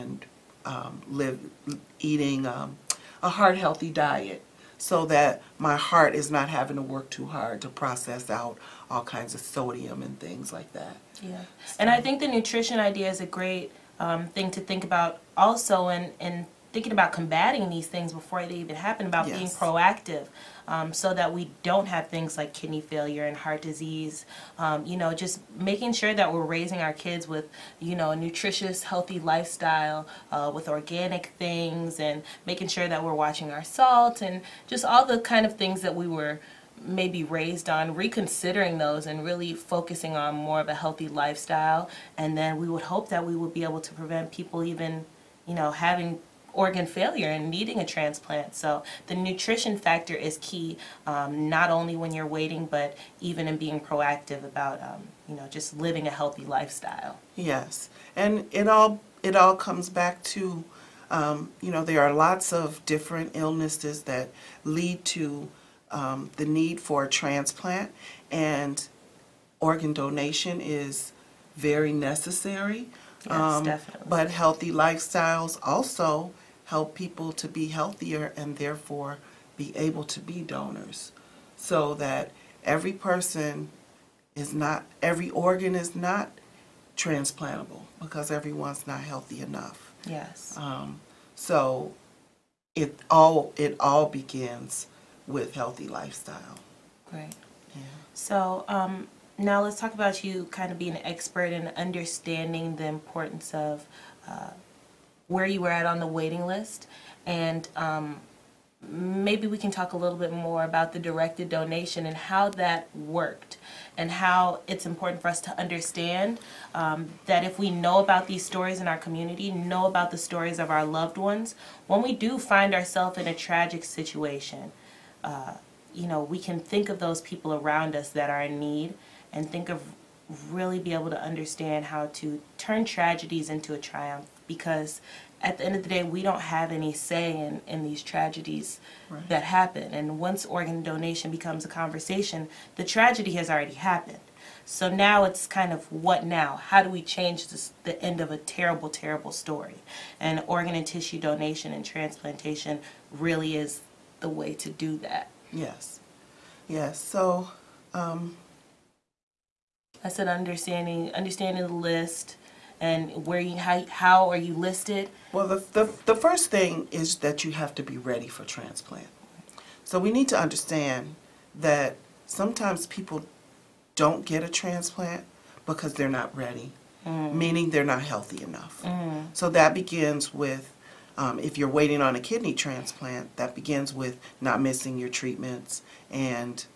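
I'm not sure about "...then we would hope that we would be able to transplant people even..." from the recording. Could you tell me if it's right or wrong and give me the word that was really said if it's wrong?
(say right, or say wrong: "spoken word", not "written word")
wrong: "prevent", not "transplant".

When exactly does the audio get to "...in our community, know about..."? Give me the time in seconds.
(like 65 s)
118 s.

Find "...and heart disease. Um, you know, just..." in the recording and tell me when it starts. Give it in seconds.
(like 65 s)
23 s.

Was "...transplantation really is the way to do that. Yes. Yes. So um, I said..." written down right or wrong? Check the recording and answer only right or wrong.
right.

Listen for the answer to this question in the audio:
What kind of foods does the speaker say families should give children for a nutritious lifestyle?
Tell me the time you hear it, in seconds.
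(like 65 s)
30 s.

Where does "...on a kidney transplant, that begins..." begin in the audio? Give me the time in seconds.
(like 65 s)
182 s.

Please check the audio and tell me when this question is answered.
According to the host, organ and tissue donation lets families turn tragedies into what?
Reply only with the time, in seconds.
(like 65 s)
133 s.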